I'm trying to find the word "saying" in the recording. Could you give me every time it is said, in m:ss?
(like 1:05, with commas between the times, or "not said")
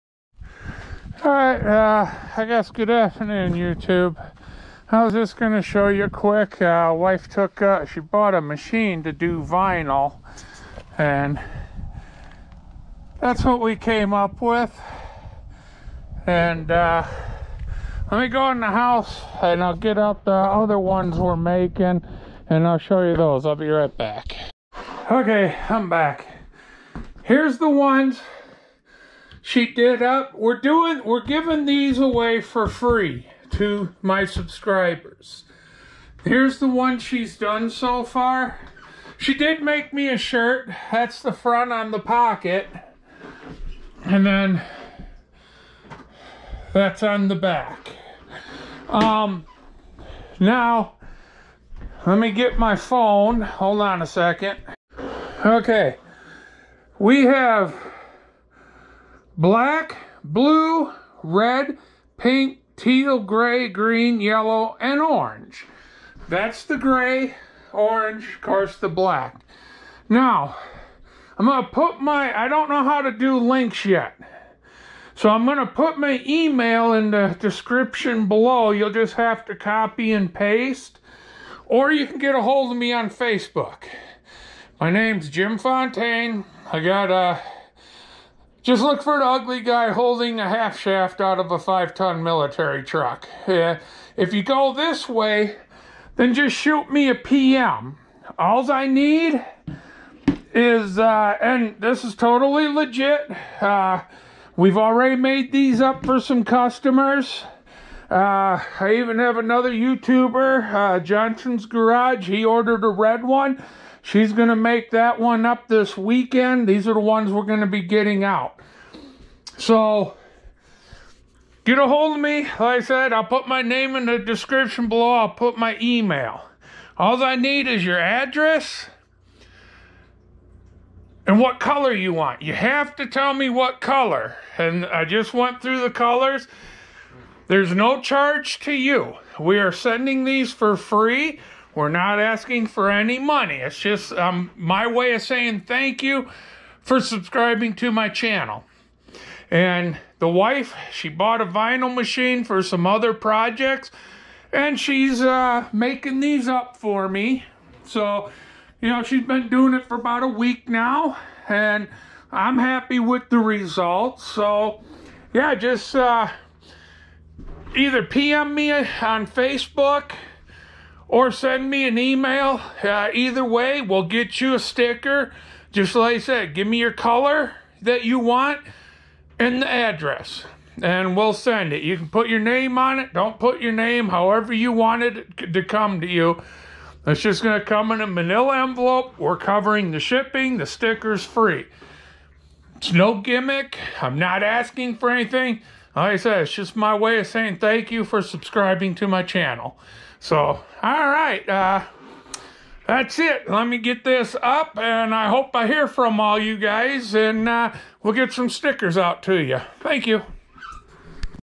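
2:25, 3:17.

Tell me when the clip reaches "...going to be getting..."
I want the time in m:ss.
1:57.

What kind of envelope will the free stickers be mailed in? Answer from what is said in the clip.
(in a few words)
Manila envelope.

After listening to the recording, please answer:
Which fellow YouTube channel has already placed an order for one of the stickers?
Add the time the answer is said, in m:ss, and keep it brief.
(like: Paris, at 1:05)
Johnson's Garage, at 1:50.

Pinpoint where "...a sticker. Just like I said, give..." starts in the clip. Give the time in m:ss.
2:54.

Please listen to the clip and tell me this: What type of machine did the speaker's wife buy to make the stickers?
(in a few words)
Vinyl machine.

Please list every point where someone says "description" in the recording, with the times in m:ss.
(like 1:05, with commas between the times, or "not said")
1:17, 2:04.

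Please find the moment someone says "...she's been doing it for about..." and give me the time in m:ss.
2:39.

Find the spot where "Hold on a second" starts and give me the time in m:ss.
0:53.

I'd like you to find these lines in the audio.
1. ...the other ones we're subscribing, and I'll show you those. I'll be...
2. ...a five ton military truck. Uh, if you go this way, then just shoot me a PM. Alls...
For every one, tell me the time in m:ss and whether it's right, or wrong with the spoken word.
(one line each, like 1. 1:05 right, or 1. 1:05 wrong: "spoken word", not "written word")
1. 0:20 wrong: "making", not "subscribing"
2. 1:31 right.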